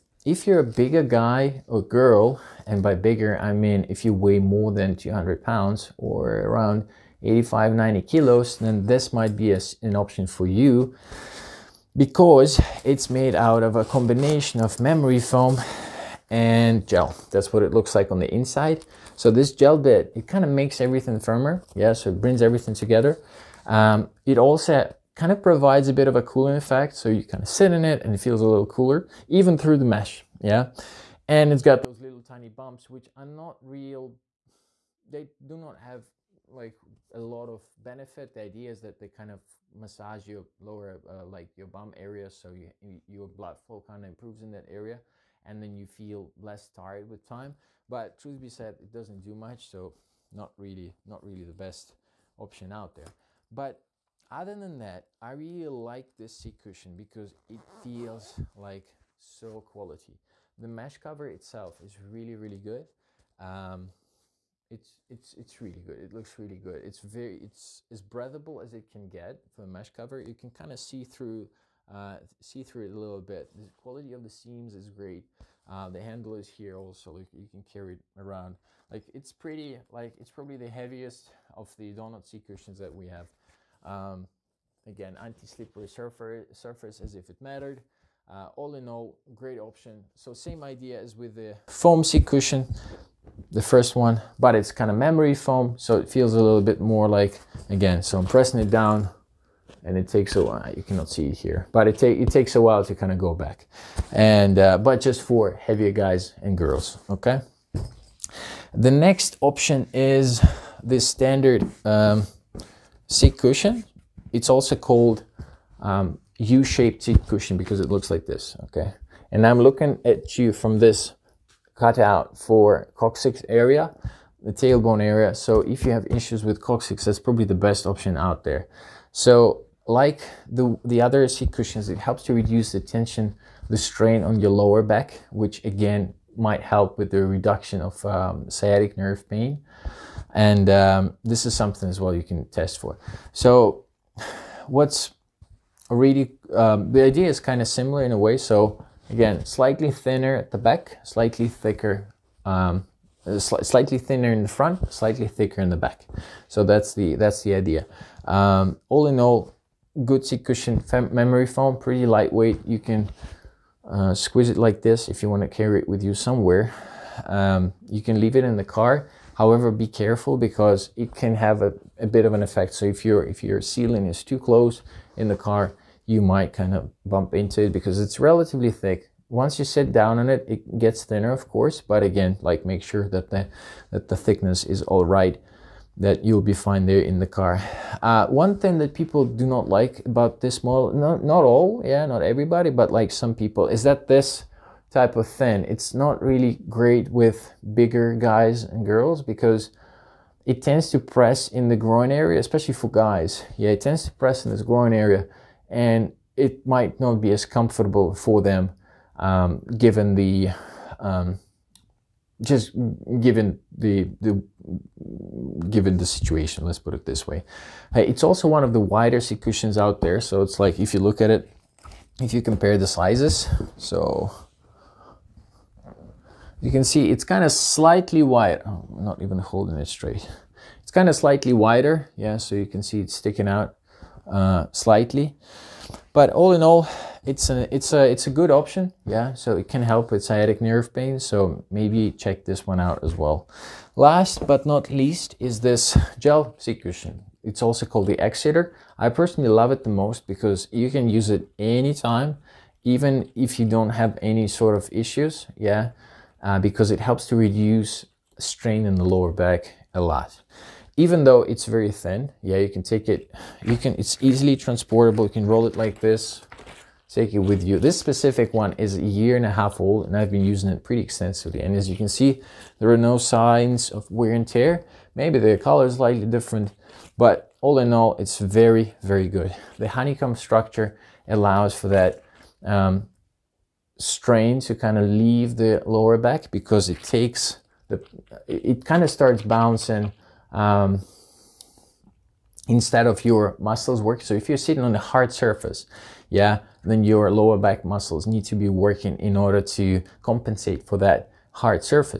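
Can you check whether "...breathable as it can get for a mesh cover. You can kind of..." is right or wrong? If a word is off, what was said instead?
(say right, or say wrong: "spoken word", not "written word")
right.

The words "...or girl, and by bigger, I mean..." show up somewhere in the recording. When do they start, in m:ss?
0:01.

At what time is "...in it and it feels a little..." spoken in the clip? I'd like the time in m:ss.
0:27.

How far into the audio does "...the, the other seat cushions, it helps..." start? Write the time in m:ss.
2:10.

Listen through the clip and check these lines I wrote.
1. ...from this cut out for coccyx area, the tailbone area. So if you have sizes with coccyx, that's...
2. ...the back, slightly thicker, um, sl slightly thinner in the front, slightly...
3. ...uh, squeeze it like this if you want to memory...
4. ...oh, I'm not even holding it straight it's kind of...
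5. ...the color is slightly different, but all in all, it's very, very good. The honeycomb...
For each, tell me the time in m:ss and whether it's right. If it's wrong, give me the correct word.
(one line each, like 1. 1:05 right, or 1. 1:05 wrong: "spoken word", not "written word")
1. 2:00 wrong: "issues", not "sizes"
2. 2:30 right
3. 2:43 wrong: "carry", not "memory"
4. 3:48 right
5. 4:35 right.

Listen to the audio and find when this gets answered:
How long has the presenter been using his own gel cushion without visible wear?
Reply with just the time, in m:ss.
4:28.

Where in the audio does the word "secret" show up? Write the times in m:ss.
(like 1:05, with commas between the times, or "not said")
not said.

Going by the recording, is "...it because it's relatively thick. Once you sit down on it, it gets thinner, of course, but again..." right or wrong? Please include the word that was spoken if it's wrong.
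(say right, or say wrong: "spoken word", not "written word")
right.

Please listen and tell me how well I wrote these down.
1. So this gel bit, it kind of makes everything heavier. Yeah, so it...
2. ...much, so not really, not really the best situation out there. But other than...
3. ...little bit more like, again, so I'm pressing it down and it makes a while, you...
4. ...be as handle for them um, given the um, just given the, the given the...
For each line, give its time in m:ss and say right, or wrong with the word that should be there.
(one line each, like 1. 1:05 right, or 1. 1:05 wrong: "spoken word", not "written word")
1. 0:19 wrong: "firmer", not "heavier"
2. 0:49 wrong: "option", not "situation"
3. 1:36 wrong: "takes", not "makes"
4. 3:27 wrong: "comfortable", not "handle".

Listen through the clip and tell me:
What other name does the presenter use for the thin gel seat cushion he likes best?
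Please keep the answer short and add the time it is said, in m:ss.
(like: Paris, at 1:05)
Egg Sitter, at 4:08.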